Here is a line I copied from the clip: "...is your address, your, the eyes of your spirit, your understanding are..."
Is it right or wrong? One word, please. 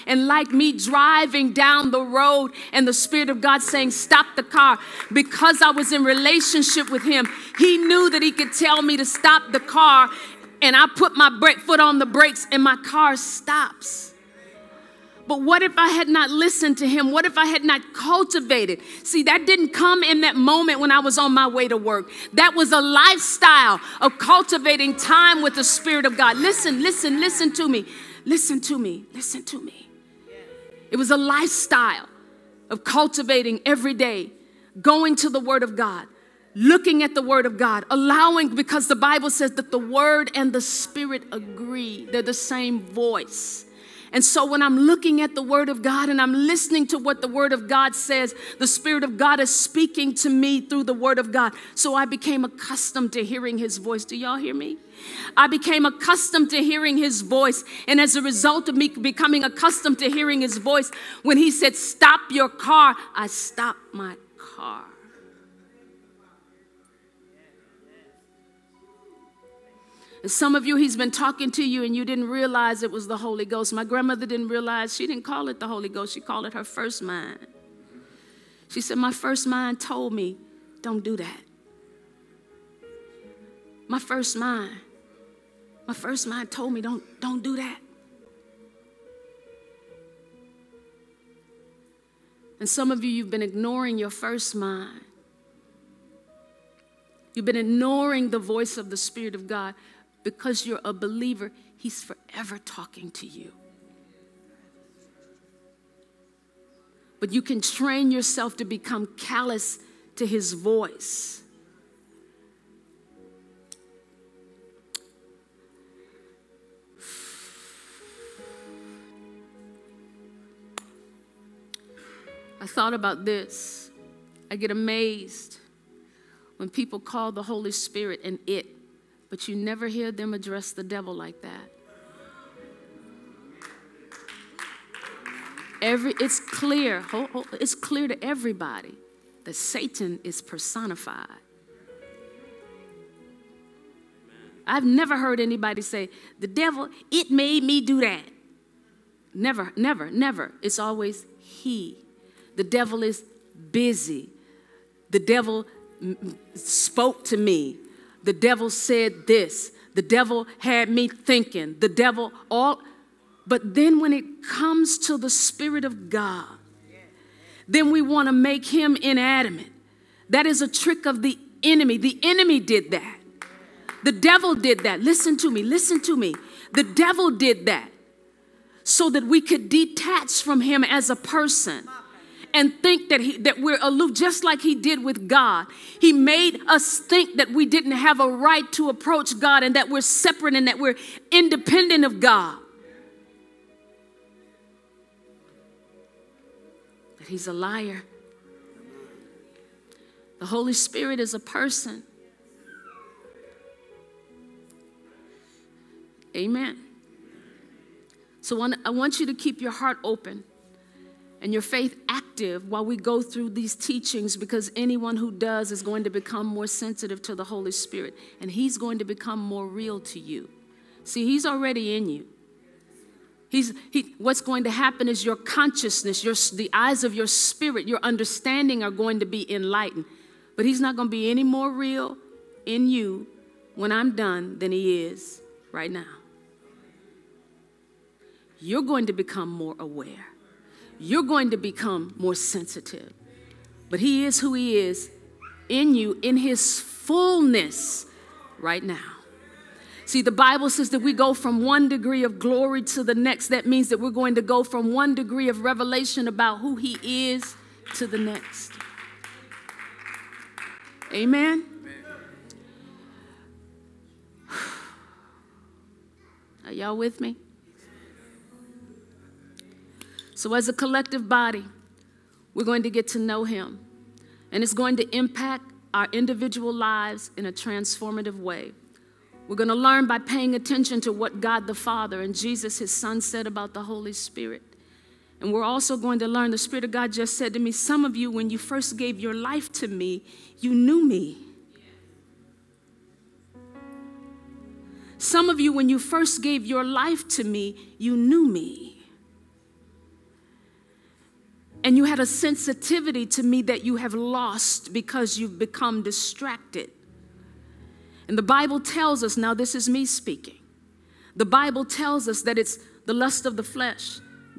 wrong.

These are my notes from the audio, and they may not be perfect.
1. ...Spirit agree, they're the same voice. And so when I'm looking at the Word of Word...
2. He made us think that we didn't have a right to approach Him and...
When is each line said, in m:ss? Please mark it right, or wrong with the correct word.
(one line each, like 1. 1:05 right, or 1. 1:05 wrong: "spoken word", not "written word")
1. 0:40 wrong: "God", not "Word"
2. 3:05 wrong: "God", not "Him".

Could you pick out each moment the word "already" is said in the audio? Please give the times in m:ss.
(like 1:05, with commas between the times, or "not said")
3:41.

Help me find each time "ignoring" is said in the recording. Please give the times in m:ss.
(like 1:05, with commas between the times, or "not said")
1:33, 1:37.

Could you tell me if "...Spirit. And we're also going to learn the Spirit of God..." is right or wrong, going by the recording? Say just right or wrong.
right.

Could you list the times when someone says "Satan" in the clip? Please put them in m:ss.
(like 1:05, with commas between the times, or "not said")
2:19.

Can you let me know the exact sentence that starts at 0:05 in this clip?
Because I was in relationship with Him, He knew that He could tell me to stop the car.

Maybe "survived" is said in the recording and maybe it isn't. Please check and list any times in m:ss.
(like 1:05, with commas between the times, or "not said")
not said.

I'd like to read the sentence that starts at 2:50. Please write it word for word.
That is a trick of the enemy.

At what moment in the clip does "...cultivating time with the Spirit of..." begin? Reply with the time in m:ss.
0:24.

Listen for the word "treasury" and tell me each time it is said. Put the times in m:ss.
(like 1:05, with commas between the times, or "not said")
not said.